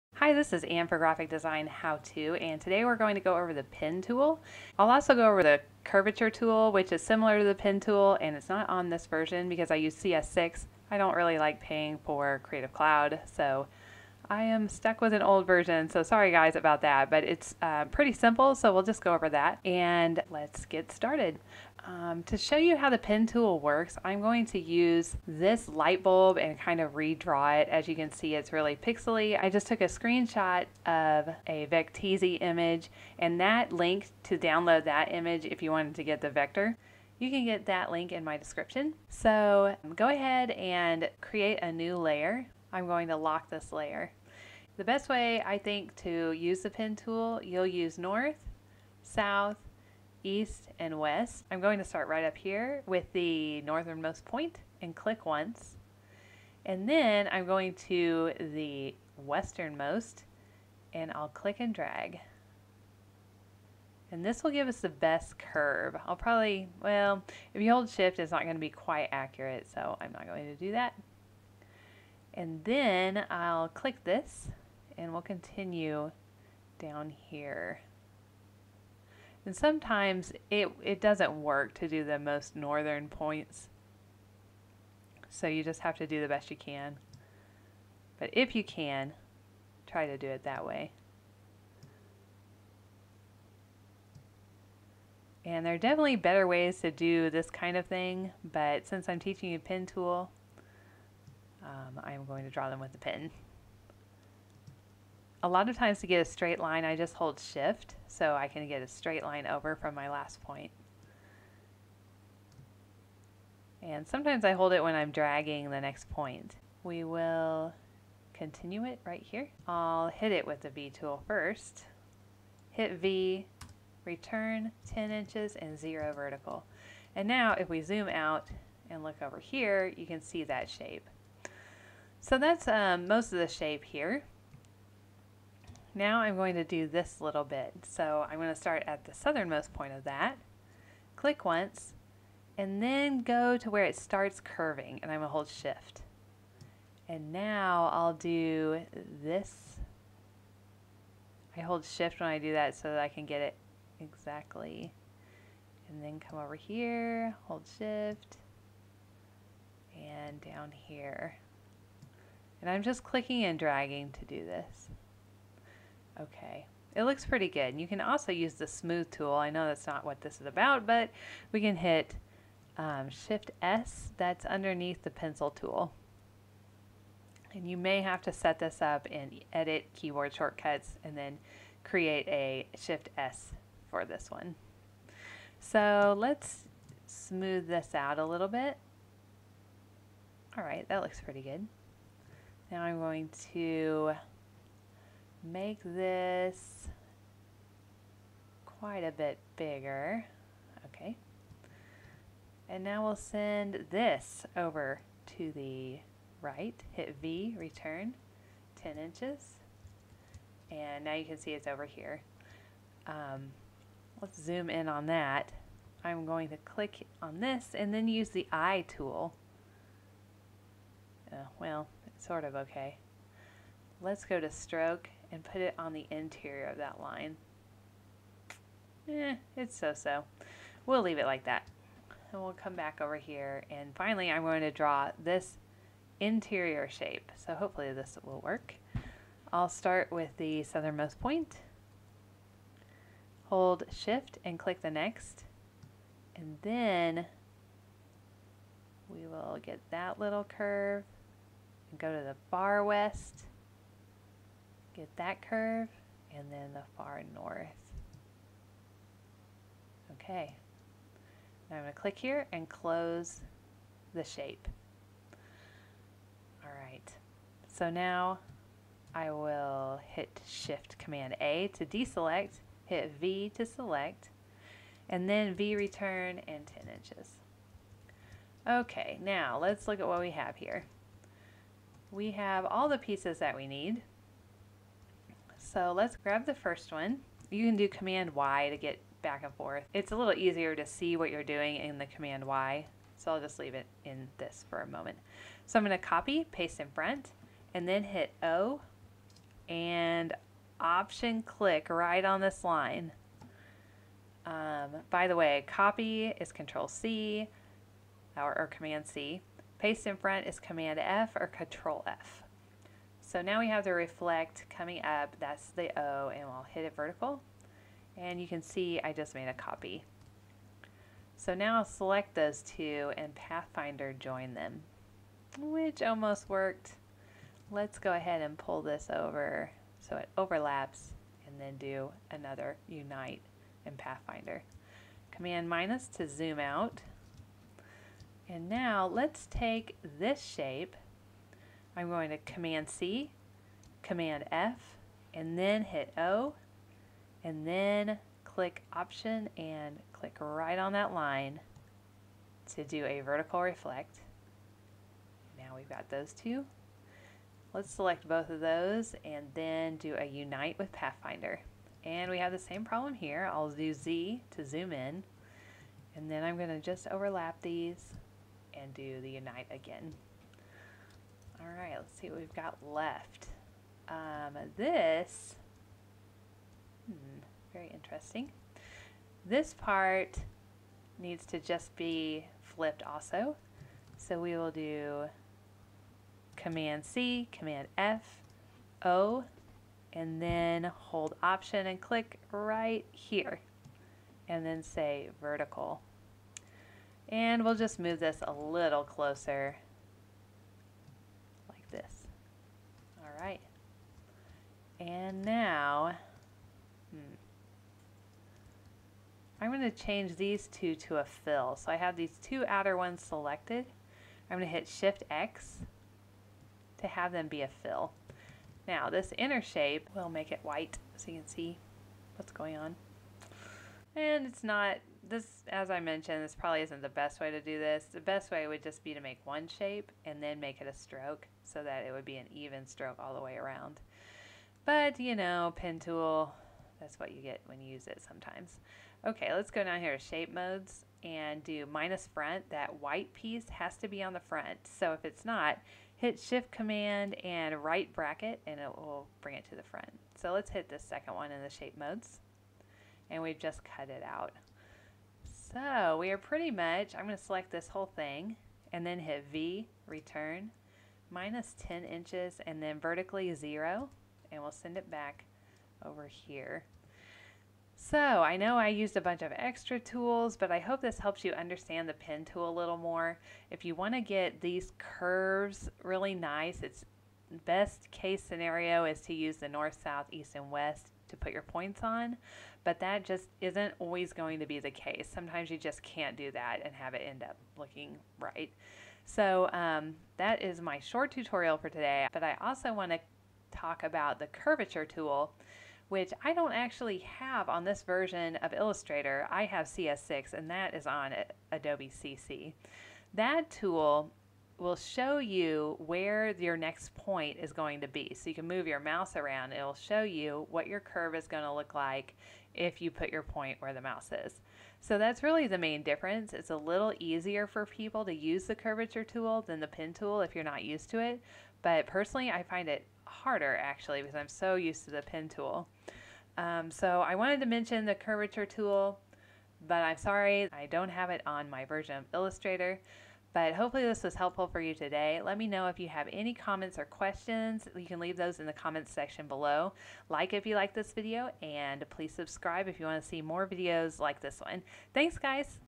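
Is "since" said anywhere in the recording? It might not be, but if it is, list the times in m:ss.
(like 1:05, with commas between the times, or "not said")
1:38.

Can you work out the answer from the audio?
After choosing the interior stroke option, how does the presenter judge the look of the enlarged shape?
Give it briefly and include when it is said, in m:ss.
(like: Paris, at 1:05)
so-so, at 3:49.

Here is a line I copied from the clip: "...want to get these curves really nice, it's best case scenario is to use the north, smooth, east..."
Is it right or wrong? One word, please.
wrong.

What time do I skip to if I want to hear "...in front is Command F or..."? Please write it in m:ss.
5:10.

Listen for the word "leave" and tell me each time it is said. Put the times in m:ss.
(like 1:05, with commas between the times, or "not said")
3:51, 4:53, 8:58.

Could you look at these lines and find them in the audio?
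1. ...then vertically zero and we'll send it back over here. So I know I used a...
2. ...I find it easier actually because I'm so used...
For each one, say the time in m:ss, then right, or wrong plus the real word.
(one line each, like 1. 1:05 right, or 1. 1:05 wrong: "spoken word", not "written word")
1. 7:42 right
2. 8:42 wrong: "harder", not "easier".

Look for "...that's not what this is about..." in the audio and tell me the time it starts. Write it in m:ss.
2:49.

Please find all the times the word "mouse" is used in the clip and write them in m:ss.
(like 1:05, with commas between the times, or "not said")
8:28, 8:34.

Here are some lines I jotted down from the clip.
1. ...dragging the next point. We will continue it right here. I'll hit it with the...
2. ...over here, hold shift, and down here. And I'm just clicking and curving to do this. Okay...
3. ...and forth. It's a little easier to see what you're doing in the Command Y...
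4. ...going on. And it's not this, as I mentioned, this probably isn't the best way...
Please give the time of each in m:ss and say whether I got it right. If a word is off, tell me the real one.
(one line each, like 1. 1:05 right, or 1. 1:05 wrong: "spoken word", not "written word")
1. 1:55 right
2. 2:36 wrong: "dragging", not "curving"
3. 4:49 right
4. 7:02 right.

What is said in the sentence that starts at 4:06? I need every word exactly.
And then we will get that little curve and go to the far west.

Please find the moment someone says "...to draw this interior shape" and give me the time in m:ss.
3:54.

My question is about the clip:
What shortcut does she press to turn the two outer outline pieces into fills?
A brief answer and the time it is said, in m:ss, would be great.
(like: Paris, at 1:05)
Shift X, at 6:54.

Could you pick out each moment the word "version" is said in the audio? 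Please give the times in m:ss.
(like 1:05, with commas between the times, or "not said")
0:09, 0:15, 8:18, 8:51.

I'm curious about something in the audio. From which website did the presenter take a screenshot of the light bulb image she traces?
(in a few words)
Vecteezy.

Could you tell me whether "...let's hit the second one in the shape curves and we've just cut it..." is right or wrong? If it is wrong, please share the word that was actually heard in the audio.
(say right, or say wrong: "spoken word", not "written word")
wrong: "modes", not "curves".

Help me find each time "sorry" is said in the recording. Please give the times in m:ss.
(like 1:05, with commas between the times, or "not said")
0:16, 8:50.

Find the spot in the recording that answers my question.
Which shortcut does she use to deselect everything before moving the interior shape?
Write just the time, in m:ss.
4:30.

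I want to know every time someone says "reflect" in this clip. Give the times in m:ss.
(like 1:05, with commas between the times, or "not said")
5:13, 5:53.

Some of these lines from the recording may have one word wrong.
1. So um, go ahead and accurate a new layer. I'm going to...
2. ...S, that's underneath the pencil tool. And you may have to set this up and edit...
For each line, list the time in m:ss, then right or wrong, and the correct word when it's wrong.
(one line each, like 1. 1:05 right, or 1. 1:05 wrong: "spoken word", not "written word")
1. 0:39 wrong: "create", not "accurate"
2. 2:53 right.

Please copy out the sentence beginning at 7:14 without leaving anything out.
But, you know, pen tool, that's what you get when you use it sometimes.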